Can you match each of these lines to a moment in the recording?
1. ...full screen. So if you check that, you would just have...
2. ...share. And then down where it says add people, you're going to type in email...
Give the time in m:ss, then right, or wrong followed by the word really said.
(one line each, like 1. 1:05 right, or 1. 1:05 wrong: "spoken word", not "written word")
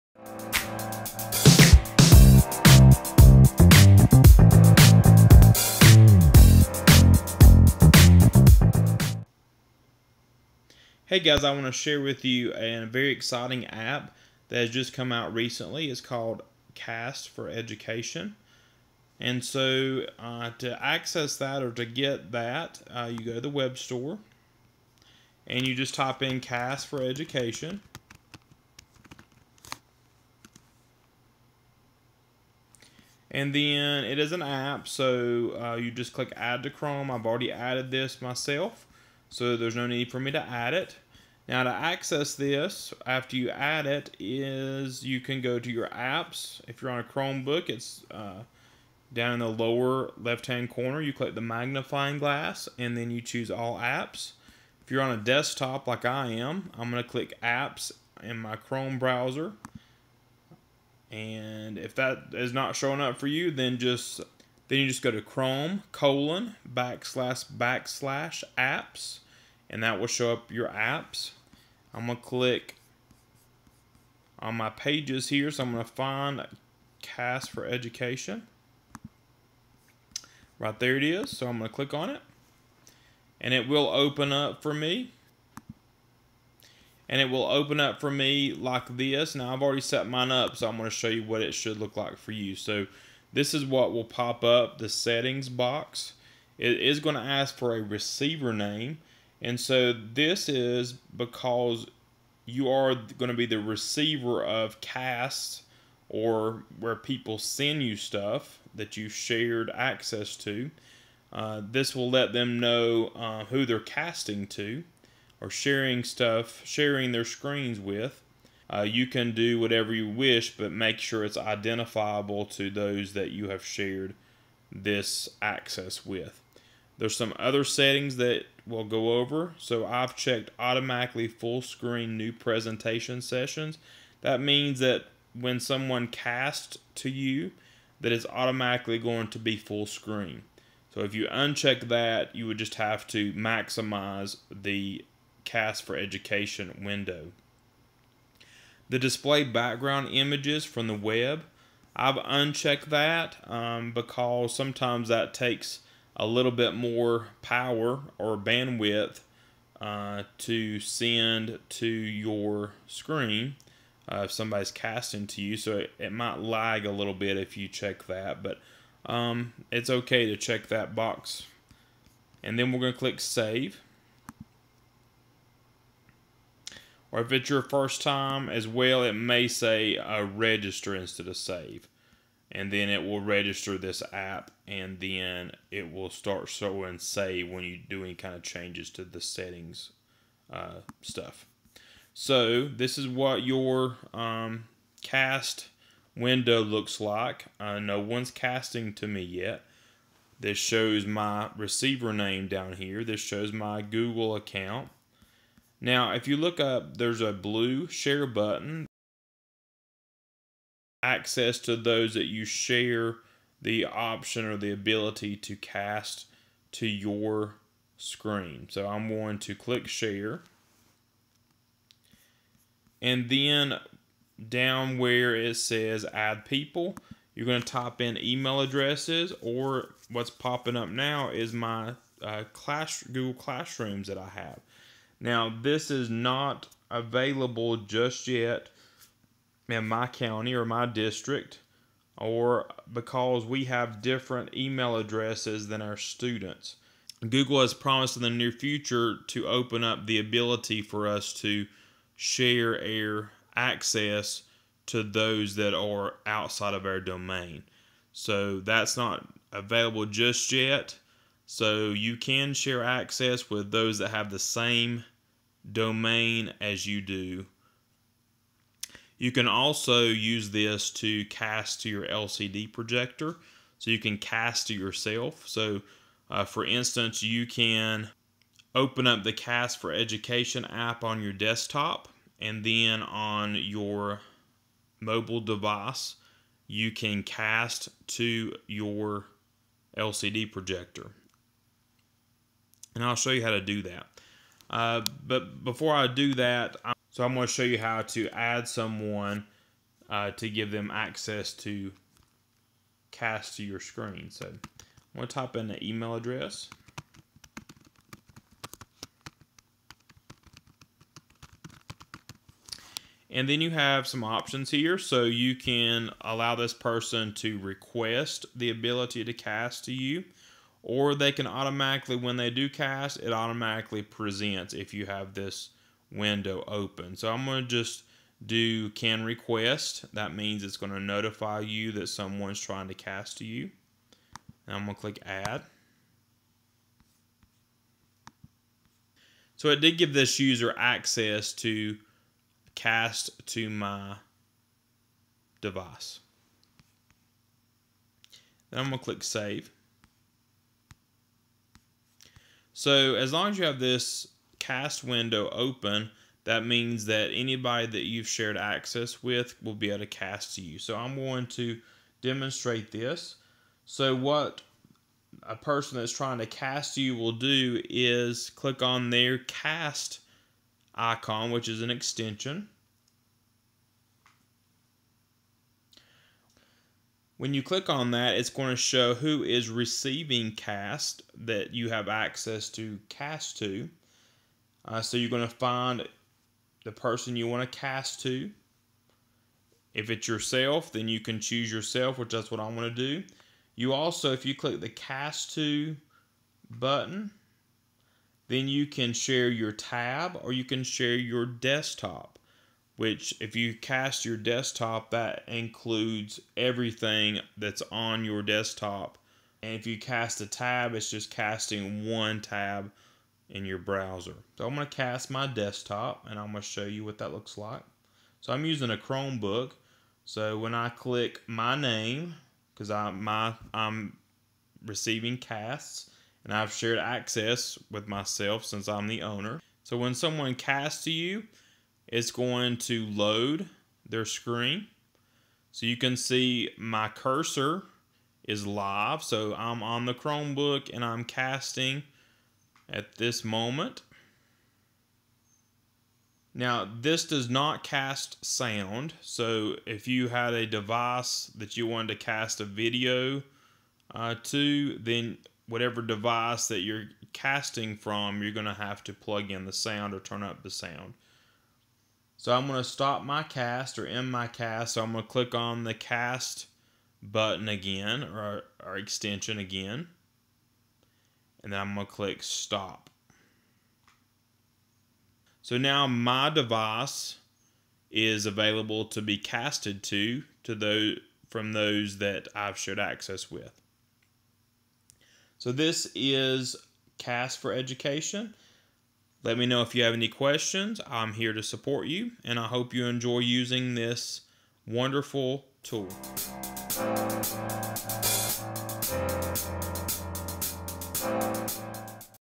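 1. 2:19 wrong: "uncheck", not "check"
2. 3:39 right.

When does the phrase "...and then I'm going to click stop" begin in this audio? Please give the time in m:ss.
7:51.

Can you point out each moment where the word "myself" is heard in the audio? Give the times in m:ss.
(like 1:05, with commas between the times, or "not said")
0:38, 7:08.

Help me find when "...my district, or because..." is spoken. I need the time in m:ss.
4:00.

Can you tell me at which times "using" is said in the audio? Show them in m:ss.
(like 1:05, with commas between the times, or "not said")
6:58, 8:13.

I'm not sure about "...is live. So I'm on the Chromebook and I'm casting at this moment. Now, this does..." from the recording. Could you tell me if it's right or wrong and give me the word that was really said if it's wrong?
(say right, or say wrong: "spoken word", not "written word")
right.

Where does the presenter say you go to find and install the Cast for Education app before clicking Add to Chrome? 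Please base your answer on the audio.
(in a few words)
the web store.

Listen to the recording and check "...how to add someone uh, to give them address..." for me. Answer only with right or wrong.
wrong.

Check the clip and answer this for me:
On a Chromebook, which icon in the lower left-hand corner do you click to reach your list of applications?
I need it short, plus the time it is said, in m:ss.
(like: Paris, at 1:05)
magnifying glass, at 0:51.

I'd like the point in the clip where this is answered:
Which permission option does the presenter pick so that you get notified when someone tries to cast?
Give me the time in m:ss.
5:28.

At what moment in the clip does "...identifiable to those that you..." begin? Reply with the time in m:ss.
2:01.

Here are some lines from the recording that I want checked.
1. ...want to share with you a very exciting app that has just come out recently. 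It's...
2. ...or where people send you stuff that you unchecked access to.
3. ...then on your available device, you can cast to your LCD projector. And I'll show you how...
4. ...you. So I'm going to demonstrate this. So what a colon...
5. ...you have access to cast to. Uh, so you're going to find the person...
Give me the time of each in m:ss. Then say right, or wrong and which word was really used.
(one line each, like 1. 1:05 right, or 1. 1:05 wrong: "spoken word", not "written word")
1. 0:11 right
2. 1:46 wrong: "shared", not "unchecked"
3. 4:42 wrong: "mobile", not "available"
4. 6:00 wrong: "person", not "colon"
5. 6:21 right.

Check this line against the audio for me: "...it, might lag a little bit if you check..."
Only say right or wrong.
right.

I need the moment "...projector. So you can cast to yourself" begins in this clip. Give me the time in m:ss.
4:32.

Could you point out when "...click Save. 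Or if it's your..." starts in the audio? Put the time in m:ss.
2:52.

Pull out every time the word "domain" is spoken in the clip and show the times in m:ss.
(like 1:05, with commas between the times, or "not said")
4:16, 4:25.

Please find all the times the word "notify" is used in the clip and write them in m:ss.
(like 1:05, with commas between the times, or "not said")
5:30.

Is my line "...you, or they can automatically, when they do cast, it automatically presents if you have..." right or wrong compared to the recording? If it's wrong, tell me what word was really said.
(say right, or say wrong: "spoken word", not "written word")
right.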